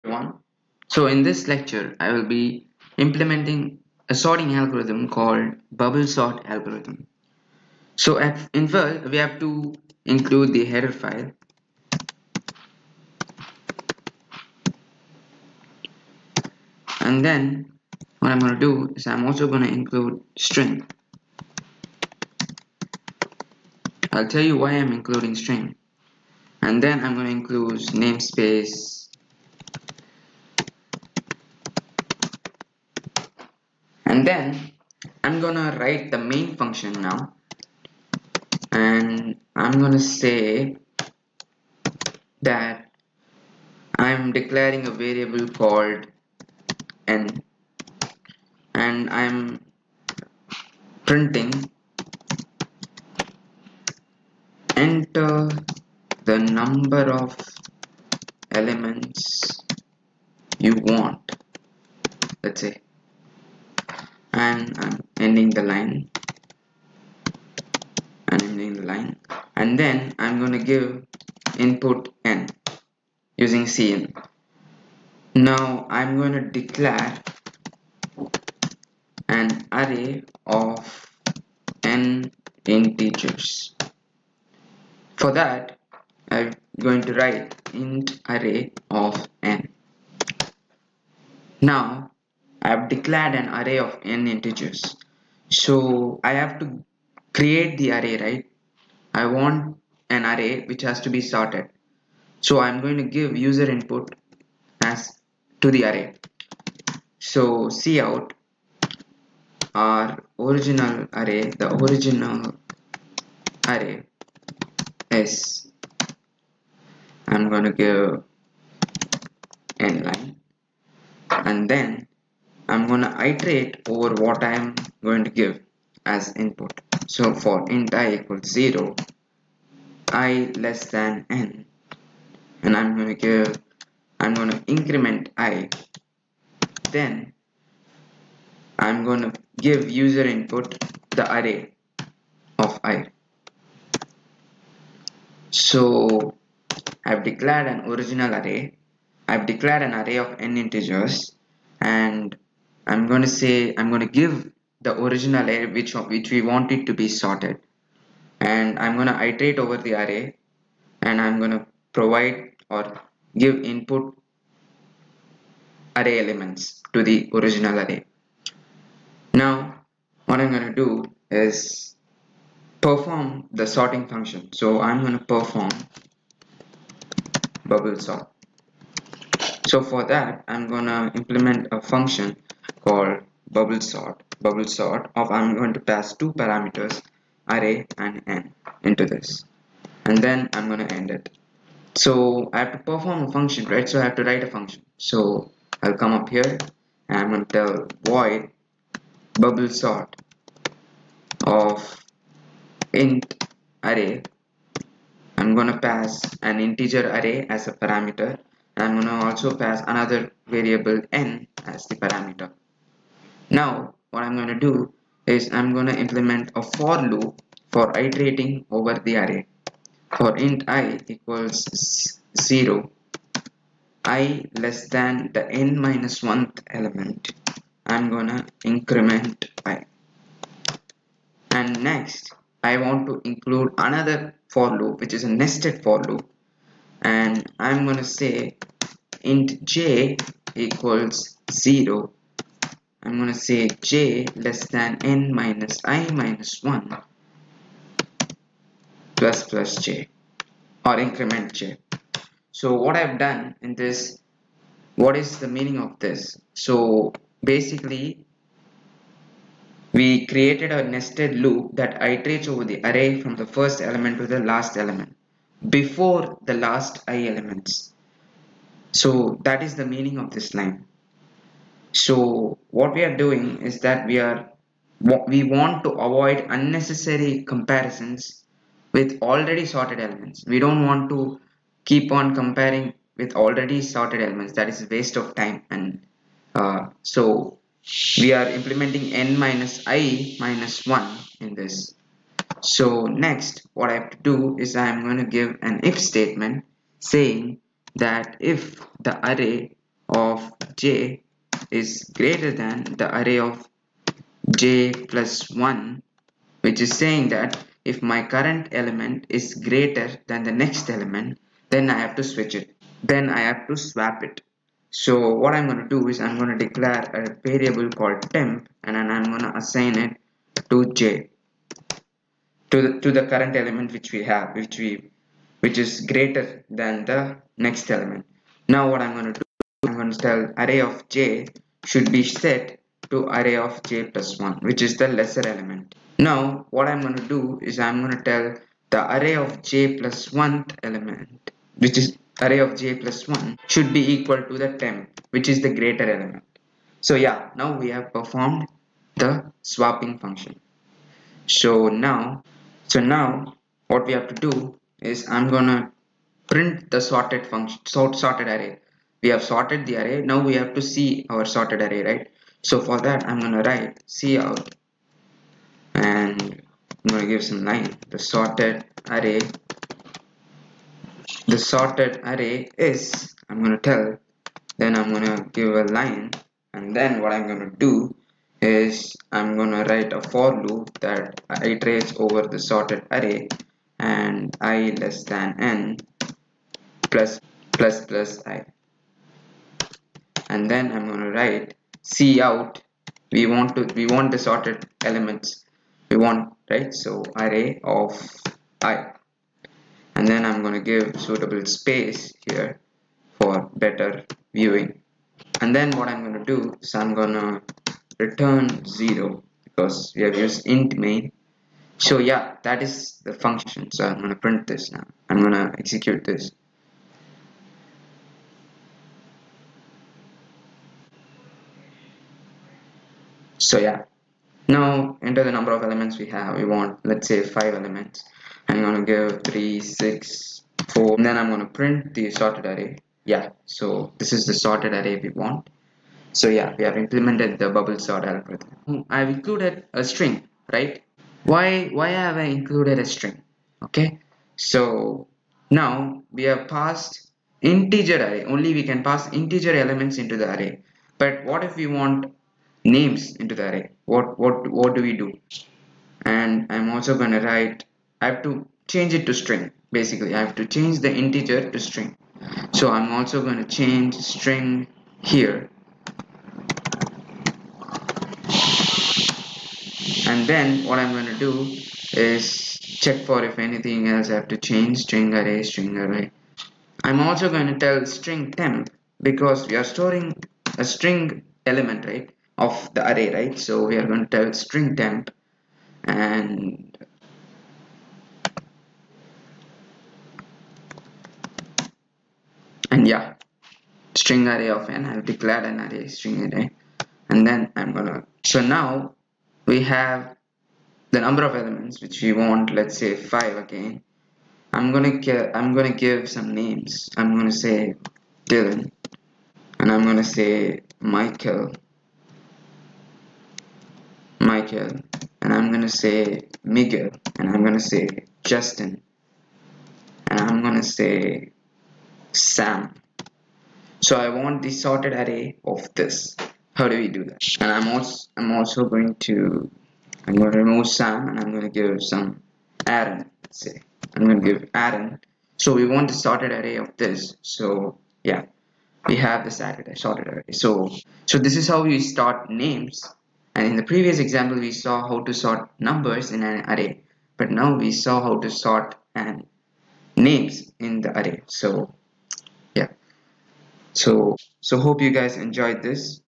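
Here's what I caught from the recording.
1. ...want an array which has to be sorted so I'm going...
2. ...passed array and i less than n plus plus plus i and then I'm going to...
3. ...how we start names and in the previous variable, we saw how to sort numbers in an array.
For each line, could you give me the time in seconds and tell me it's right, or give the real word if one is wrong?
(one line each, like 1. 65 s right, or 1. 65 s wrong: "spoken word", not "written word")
1. 99 s right
2. 382 s wrong: "sorted", not "passed"
3. 541 s wrong: "example", not "variable".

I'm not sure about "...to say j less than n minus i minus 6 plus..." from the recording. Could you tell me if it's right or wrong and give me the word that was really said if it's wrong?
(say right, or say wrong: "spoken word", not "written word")
wrong: "1", not "6".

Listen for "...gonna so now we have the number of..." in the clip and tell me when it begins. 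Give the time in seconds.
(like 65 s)
497 s.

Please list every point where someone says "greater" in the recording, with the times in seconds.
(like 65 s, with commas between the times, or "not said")
302 s, 309 s, 326 s, 345 s.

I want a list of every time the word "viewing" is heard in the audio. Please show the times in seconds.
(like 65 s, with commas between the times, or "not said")
404 s.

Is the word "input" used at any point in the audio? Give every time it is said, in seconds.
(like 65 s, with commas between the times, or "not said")
71 s, 103 s, 126 s, 140 s, 163 s.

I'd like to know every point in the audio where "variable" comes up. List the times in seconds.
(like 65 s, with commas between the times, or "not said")
44 s, 210 s, 317 s.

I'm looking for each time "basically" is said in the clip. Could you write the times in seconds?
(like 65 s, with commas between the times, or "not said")
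257 s, 459 s.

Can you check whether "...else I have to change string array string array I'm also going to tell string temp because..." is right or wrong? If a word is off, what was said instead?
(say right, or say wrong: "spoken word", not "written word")
right.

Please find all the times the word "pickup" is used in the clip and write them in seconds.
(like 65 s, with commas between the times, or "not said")
not said.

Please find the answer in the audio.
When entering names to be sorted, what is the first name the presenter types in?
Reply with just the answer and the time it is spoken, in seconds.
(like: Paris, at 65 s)
Dylan, at 508 s.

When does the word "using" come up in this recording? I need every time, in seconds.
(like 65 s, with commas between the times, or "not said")
73 s.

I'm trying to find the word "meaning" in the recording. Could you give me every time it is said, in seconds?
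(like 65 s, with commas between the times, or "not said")
255 s, 269 s.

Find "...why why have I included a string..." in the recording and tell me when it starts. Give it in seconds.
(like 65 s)
441 s.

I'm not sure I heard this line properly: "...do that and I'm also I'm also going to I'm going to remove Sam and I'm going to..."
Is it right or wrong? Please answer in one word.
right.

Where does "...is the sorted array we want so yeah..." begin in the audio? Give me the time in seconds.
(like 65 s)
434 s.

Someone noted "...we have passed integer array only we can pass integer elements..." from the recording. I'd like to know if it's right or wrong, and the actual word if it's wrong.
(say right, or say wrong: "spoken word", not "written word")
right.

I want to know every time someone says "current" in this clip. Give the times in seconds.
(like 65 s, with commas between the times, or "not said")
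308 s, 323 s.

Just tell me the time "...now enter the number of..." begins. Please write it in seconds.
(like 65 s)
424 s.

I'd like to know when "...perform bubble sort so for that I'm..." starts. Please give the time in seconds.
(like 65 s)
175 s.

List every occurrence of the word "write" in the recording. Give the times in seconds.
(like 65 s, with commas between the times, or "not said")
35 s, 87 s, 194 s, 363 s, 379 s, 391 s, 457 s.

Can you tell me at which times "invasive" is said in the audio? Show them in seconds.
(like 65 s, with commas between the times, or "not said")
not said.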